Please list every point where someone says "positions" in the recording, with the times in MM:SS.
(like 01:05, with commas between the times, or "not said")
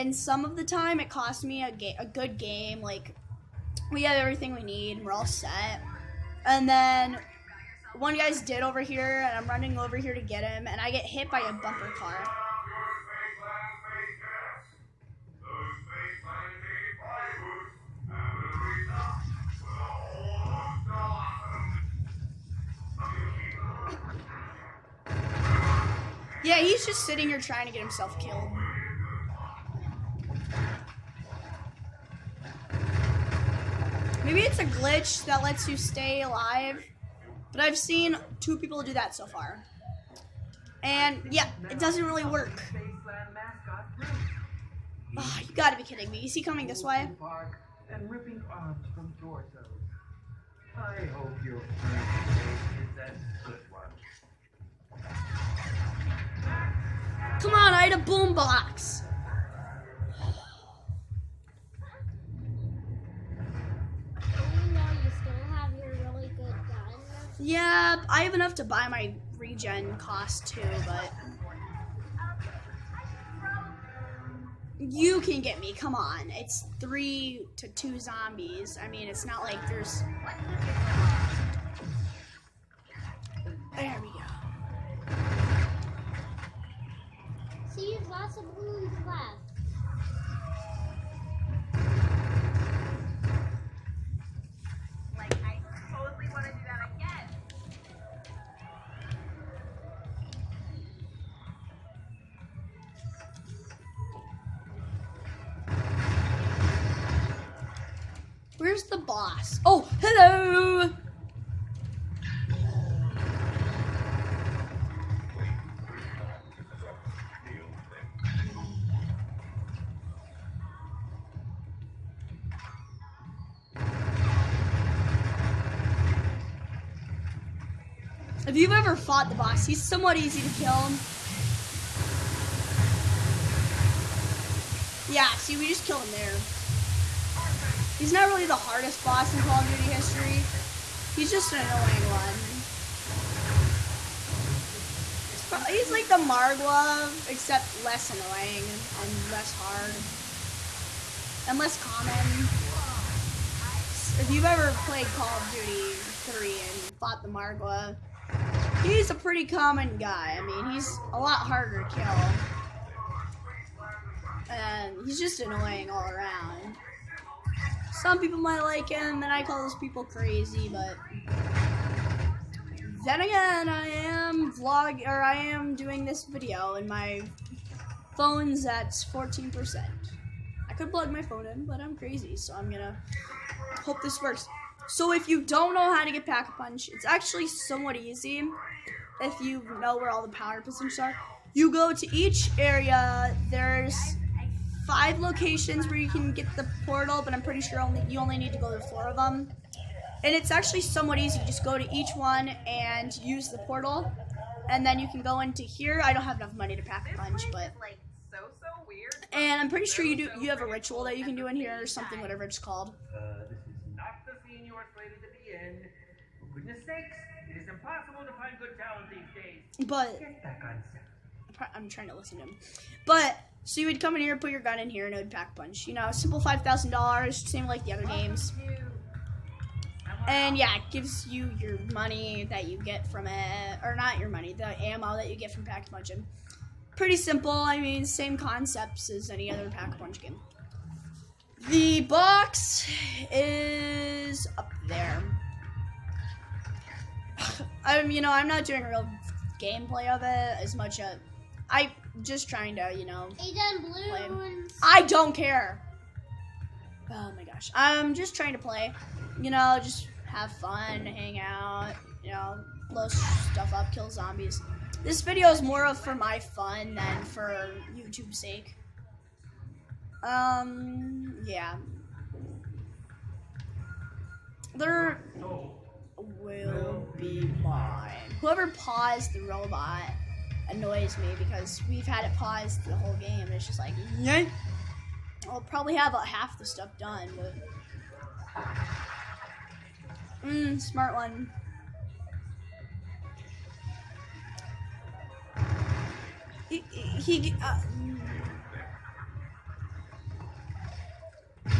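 03:10.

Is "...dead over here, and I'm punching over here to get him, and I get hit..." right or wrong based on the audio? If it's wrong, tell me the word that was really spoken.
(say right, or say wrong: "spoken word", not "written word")
wrong: "running", not "punching".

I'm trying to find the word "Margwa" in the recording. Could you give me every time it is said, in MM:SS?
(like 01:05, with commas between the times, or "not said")
02:26, 02:37.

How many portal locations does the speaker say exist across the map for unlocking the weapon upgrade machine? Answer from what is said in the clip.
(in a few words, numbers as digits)
5.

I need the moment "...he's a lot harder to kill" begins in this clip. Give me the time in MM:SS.
02:40.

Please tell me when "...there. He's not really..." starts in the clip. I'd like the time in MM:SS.
02:16.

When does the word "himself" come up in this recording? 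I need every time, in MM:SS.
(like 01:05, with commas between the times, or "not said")
00:27.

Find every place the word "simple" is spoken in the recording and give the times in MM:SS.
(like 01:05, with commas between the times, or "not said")
03:46, 03:57.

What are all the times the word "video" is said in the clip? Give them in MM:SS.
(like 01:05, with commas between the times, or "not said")
02:56, 04:25.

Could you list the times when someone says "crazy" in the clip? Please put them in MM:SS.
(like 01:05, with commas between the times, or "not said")
02:50, 03:01.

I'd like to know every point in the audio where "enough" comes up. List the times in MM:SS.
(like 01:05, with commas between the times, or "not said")
01:08, 03:26.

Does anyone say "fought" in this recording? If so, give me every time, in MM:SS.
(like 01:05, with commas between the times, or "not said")
02:09, 02:36.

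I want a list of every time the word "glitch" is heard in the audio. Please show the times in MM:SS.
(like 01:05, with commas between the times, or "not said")
00:34.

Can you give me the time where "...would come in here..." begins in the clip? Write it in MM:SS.
03:43.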